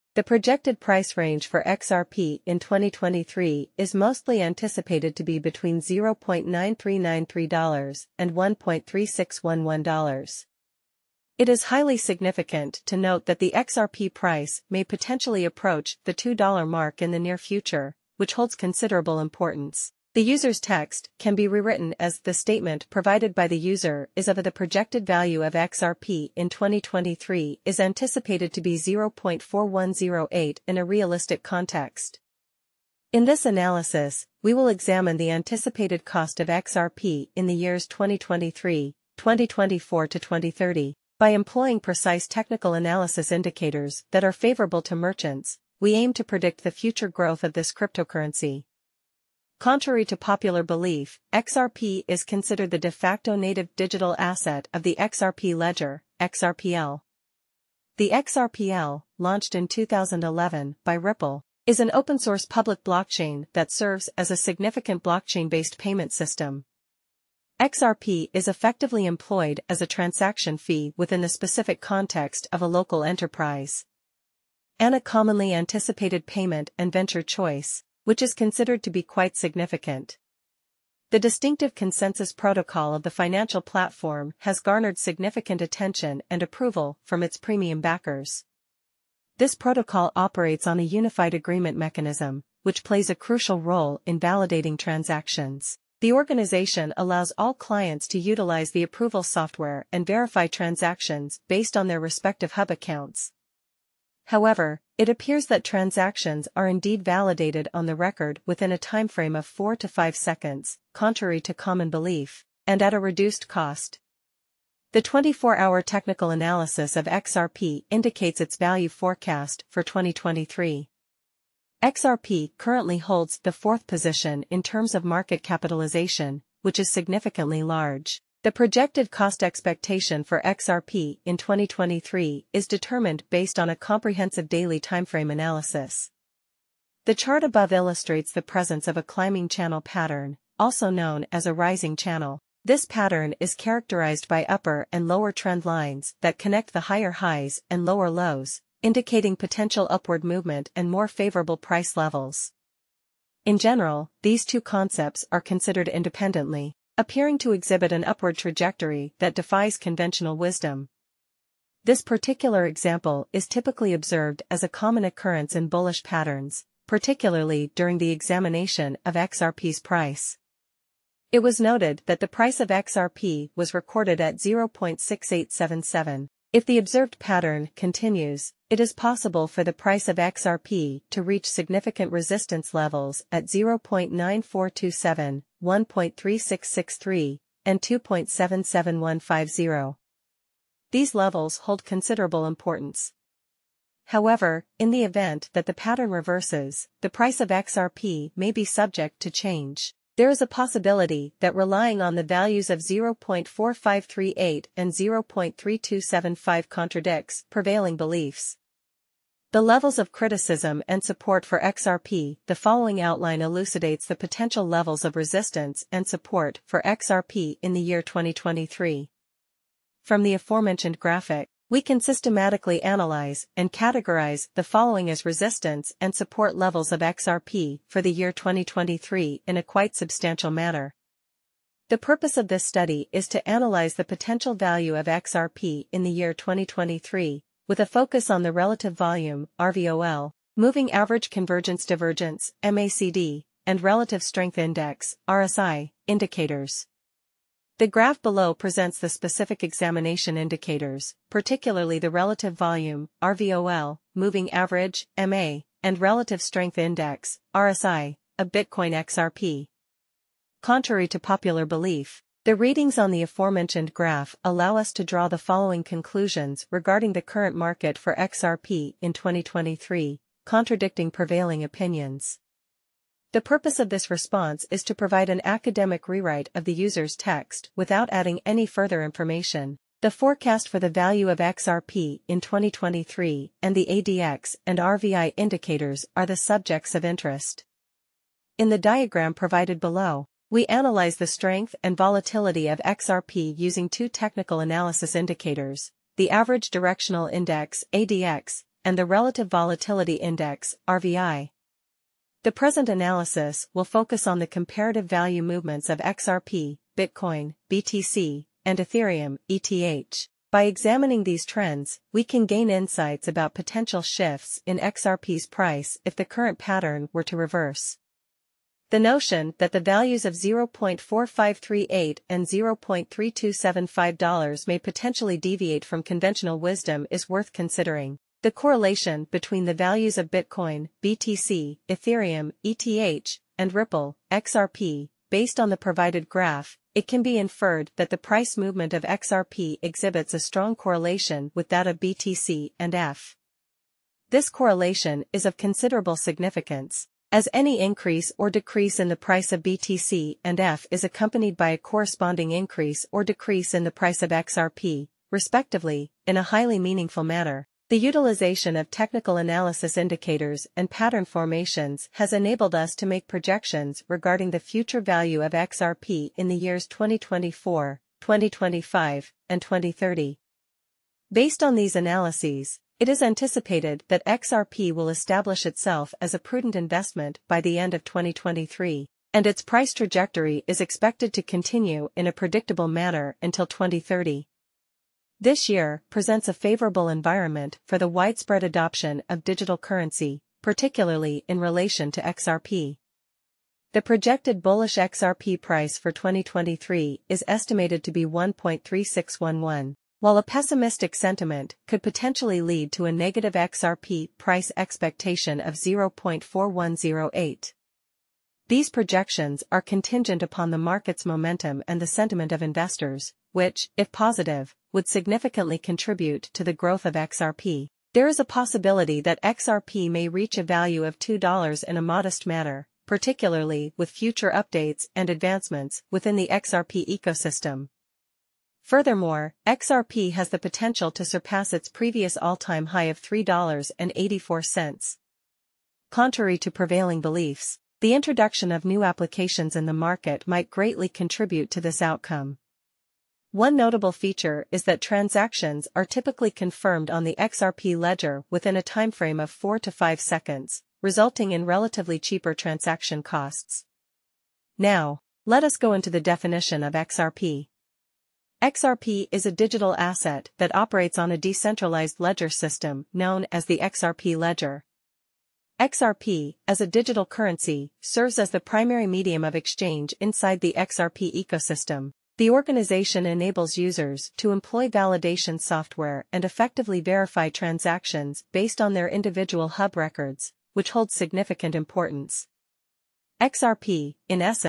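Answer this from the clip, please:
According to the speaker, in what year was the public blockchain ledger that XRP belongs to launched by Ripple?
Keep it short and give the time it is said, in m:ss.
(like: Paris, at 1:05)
2011, at 0:59.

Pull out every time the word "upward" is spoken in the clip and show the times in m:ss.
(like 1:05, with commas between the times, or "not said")
2:29, 2:38.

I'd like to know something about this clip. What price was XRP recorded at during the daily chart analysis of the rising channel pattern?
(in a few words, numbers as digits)
0.6877.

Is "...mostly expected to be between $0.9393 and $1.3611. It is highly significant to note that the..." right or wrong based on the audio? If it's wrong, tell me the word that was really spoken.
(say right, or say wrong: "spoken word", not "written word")
wrong: "anticipated", not "expected".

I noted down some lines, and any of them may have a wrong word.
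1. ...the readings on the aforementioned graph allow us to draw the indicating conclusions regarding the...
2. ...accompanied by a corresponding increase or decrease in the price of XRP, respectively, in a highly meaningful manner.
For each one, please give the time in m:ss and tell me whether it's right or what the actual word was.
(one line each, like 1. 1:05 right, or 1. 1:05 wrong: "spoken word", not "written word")
1. 4:22 wrong: "following", not "indicating"
2. 5:51 right.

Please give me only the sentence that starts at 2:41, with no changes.
This particular example is typically observed as a common occurrence in bullish patterns, particularly during the examination of XRP's price.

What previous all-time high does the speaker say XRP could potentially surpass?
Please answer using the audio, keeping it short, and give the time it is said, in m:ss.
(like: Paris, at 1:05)
$3.84, at 7:13.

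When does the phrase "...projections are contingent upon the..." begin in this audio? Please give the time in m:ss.
6:48.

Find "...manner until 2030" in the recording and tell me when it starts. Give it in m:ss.
6:22.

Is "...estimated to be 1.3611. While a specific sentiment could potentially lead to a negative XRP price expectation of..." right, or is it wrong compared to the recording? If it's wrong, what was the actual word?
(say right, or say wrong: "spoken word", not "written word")
wrong: "pessimistic", not "specific".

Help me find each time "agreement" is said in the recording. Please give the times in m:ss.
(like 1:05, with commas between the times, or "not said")
1:31.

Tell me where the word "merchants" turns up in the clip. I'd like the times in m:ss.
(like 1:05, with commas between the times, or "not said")
0:44.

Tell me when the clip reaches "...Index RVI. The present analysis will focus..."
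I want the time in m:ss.
5:00.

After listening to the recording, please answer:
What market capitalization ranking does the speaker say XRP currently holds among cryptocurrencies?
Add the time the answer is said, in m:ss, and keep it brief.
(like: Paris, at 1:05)
Fourth, at 2:03.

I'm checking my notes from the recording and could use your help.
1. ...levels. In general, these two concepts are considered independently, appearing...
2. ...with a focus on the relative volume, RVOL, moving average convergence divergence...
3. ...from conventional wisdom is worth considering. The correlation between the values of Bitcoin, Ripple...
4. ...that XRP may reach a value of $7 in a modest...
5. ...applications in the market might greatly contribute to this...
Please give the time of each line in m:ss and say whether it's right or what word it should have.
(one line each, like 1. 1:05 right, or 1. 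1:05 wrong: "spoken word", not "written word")
1. 2:31 right
2. 3:57 right
3. 5:25 wrong: "BTC", not "Ripple"
4. 6:59 wrong: "2", not "7"
5. 7:19 right.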